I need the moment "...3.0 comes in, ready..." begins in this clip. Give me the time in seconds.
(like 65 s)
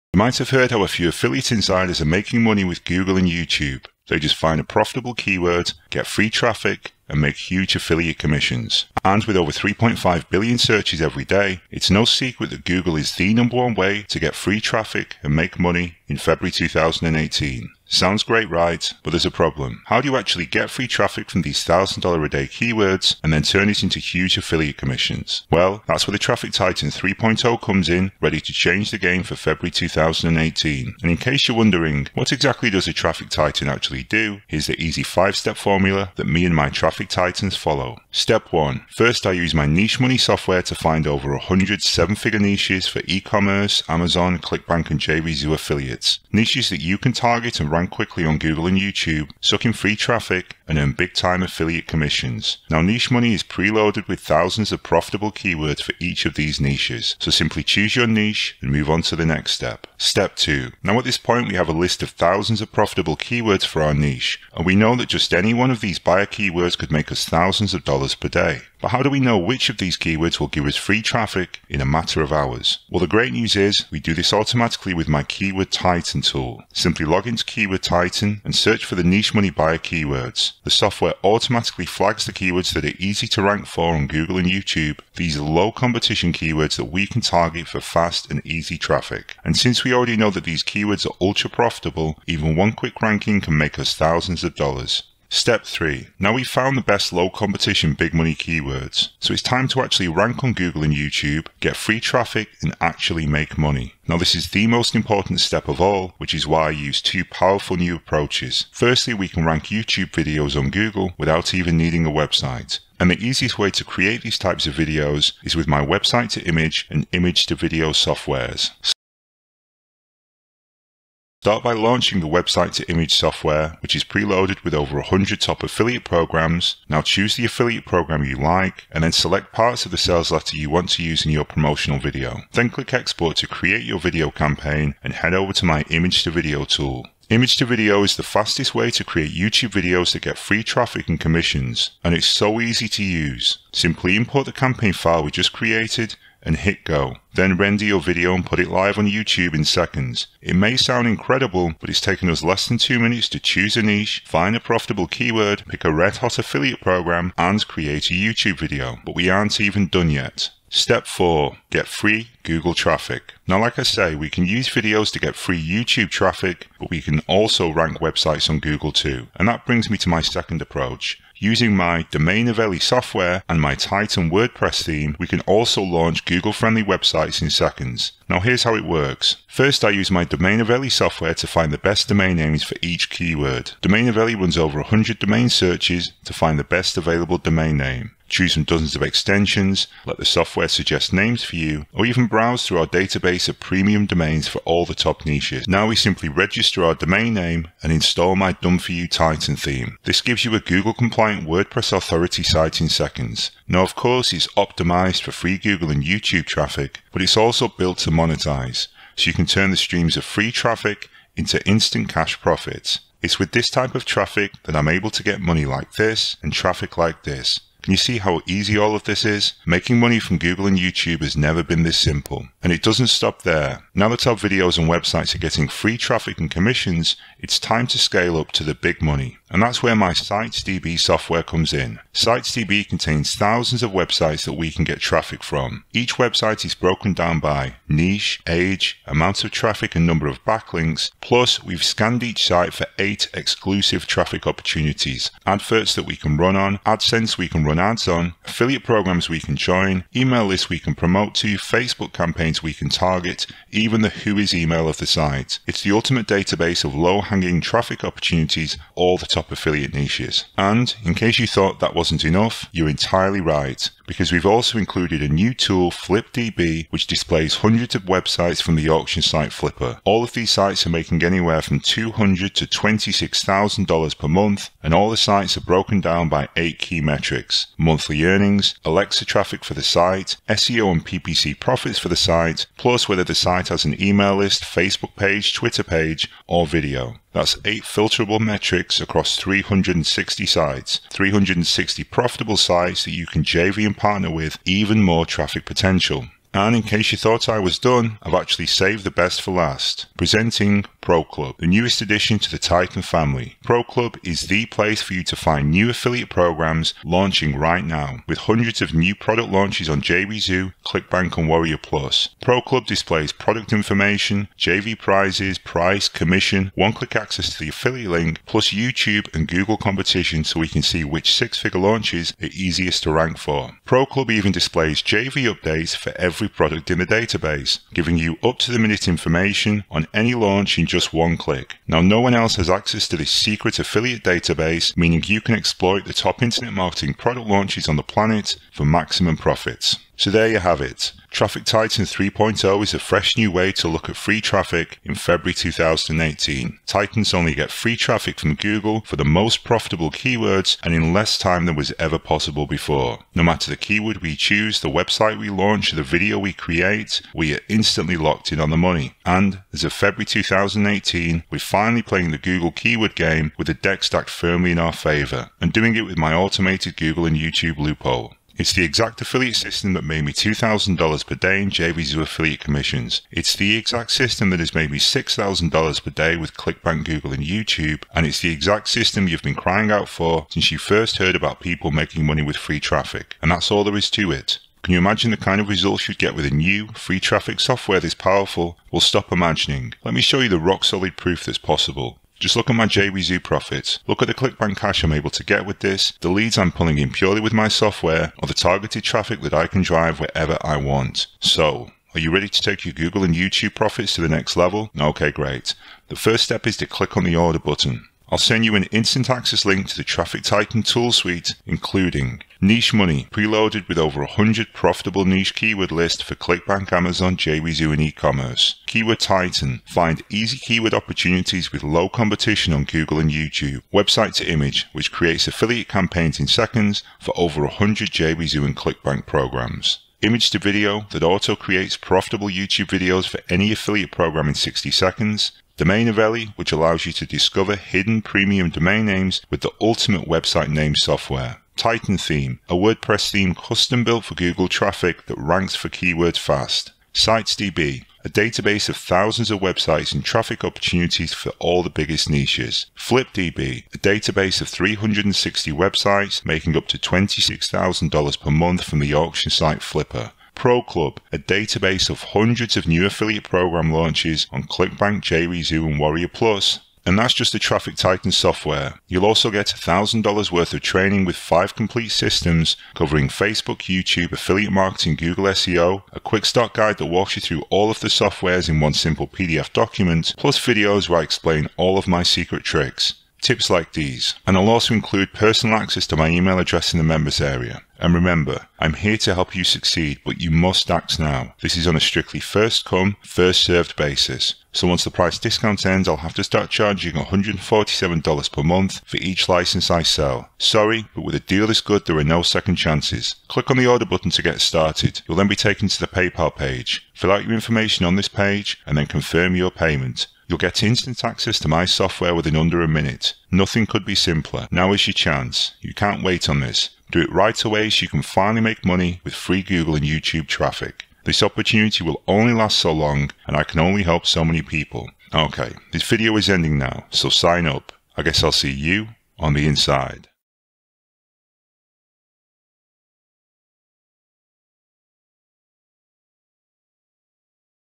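26 s.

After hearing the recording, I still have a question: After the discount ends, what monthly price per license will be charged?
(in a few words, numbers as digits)
$147.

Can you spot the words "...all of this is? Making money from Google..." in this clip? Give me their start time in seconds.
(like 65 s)
218 s.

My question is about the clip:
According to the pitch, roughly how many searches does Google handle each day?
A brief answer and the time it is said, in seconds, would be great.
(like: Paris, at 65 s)
3.5 billion, at 9 s.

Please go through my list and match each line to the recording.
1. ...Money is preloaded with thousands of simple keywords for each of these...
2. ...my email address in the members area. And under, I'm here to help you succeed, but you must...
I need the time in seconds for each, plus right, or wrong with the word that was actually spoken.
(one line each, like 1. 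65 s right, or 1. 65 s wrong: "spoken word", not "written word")
1. 53 s wrong: "profitable", not "simple"
2. 486 s wrong: "remember", not "under".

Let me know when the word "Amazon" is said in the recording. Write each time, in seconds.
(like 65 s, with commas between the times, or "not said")
43 s, 416 s.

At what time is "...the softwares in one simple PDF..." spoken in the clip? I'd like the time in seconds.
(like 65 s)
478 s.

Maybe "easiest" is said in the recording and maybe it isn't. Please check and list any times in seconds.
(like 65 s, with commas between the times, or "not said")
113 s, 322 s.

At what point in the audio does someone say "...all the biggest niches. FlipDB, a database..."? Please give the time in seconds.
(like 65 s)
451 s.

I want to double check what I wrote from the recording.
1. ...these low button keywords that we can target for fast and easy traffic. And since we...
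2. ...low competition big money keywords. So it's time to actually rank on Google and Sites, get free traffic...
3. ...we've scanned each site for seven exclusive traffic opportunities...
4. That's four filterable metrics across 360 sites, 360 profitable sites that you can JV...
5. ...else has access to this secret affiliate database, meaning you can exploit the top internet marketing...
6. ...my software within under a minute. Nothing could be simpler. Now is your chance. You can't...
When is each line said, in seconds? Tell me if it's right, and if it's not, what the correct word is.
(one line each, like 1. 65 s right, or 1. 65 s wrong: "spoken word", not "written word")
1. 85 s wrong: "competition", not "button"
2. 97 s wrong: "YouTube", not "Sites"
3. 241 s wrong: "eight", not "seven"
4. 287 s wrong: "eight", not "four"
5. 332 s right
6. 511 s right.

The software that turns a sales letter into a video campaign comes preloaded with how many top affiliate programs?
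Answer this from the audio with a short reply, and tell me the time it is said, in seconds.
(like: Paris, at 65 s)
over 100, at 124 s.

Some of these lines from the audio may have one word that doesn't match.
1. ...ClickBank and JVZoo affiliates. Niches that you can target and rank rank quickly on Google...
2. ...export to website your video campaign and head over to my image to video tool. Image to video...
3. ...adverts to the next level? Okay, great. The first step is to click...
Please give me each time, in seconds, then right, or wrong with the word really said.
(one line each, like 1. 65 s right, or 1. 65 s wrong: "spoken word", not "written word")
1. 44 s right
2. 132 s wrong: "create", not "website"
3. 403 s wrong: "profits", not "adverts".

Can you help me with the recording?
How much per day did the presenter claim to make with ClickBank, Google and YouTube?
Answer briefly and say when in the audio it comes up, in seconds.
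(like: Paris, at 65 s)
$6,000, at 374 s.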